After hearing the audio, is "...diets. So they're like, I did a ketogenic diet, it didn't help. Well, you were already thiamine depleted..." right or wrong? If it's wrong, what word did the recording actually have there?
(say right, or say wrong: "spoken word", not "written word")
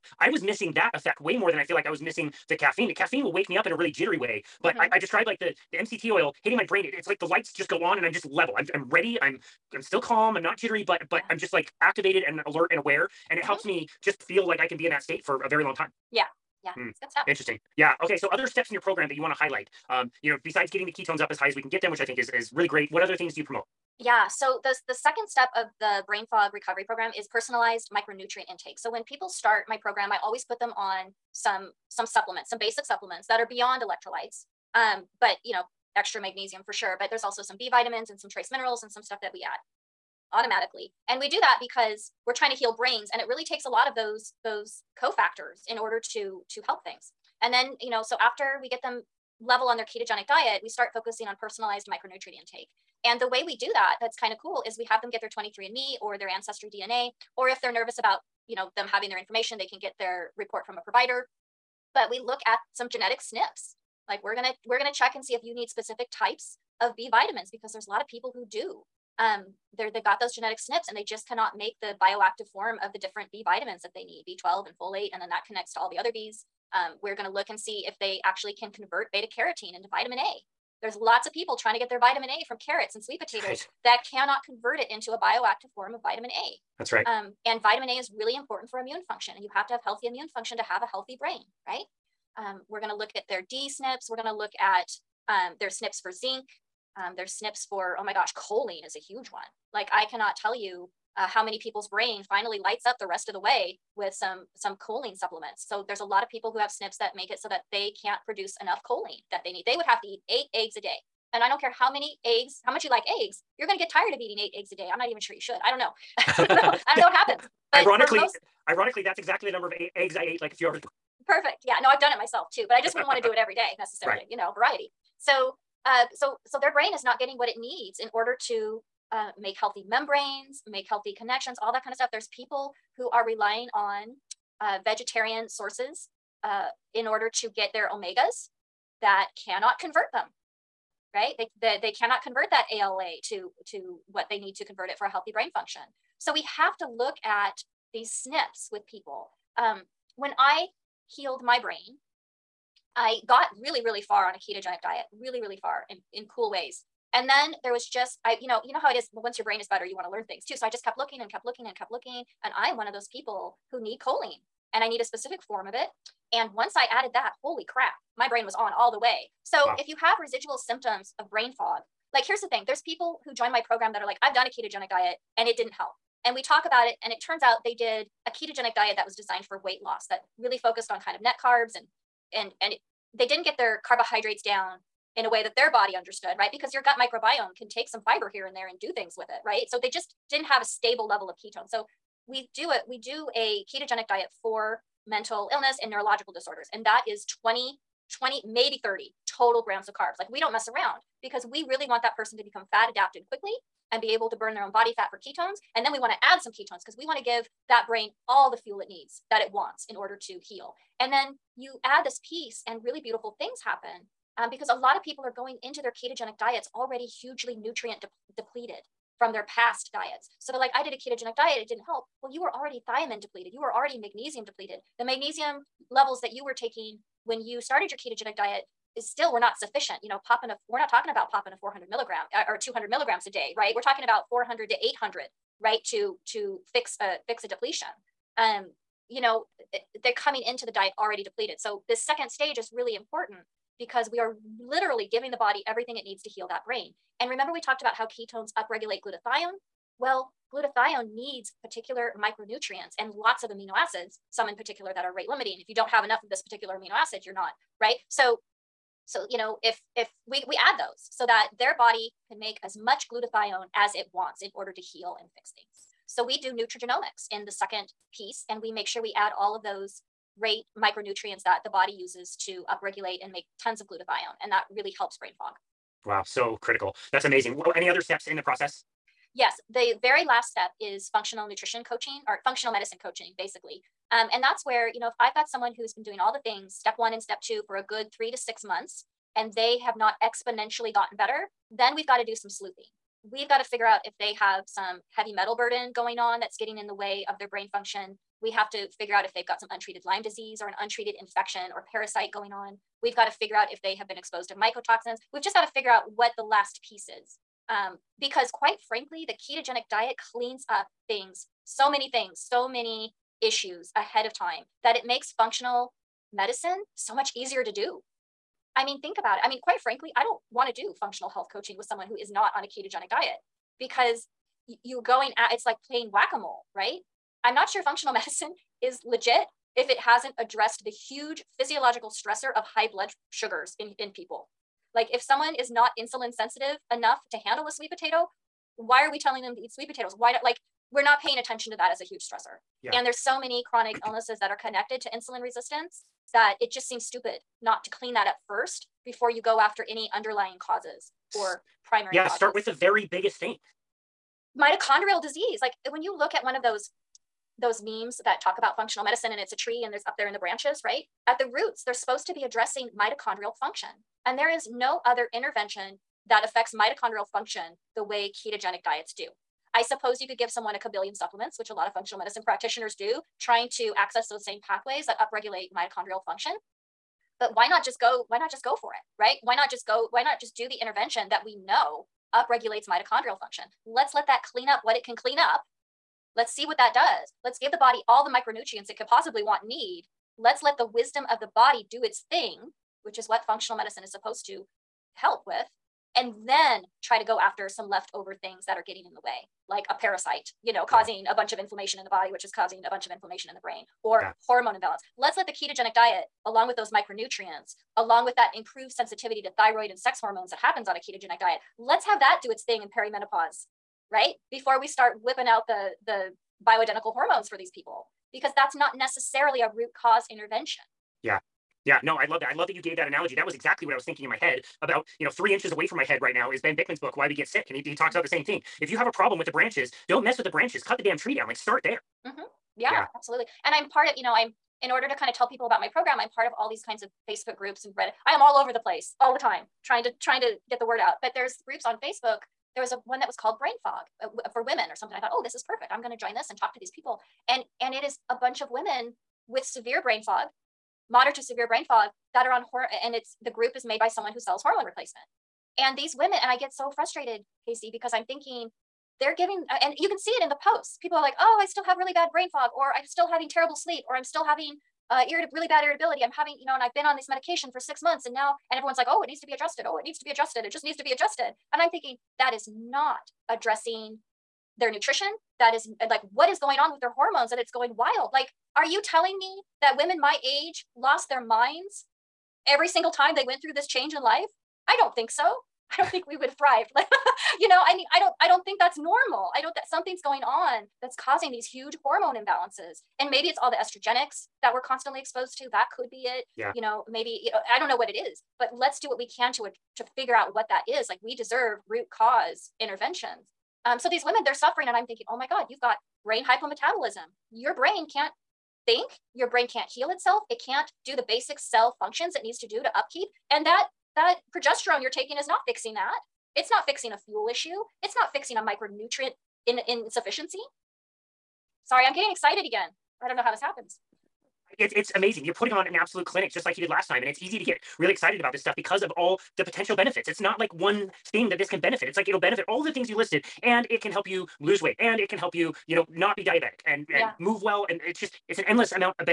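right.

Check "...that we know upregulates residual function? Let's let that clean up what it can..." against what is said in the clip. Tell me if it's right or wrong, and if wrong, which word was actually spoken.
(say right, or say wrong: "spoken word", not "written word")
wrong: "mitochondrial", not "residual".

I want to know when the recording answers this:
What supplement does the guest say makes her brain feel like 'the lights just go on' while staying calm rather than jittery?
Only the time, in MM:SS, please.
00:05.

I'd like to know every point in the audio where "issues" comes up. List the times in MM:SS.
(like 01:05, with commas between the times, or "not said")
05:13, 08:37.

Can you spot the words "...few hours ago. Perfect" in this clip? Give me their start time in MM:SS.
02:00.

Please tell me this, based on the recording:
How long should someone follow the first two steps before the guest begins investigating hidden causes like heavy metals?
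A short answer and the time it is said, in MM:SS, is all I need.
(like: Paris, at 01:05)
3 to 6 months, at 04:48.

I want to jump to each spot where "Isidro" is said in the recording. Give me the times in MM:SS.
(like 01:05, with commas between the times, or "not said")
not said.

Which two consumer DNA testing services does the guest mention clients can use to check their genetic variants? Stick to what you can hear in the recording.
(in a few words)
23andMe or Ancestry DNA.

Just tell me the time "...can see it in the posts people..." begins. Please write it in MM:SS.
07:40.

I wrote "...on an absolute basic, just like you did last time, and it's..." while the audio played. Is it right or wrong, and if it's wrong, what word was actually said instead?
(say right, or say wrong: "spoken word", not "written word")
wrong: "clinic", not "basic".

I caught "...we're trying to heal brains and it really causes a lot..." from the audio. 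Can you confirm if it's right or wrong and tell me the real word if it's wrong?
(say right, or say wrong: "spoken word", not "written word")
wrong: "takes", not "causes".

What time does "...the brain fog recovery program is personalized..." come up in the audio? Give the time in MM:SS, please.
00:25.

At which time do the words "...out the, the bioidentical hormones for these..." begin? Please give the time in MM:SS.
06:55.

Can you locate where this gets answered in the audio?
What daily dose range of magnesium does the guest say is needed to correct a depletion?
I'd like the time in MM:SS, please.
03:54.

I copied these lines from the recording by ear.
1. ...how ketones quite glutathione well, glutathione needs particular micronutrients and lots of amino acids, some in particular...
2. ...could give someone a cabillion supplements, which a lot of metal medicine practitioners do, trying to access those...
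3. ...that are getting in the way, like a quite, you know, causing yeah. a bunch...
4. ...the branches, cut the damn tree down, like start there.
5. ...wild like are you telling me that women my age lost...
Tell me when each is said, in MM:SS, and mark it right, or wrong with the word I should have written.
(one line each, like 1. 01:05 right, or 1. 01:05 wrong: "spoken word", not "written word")
1. 04:07 wrong: "upregulate", not "quite"
2. 06:10 wrong: "functional", not "metal"
3. 06:38 wrong: "parasite", not "quite"
4. 07:10 right
5. 07:57 right.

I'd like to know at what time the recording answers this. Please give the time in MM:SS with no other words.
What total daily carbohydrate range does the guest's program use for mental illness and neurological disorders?
03:17.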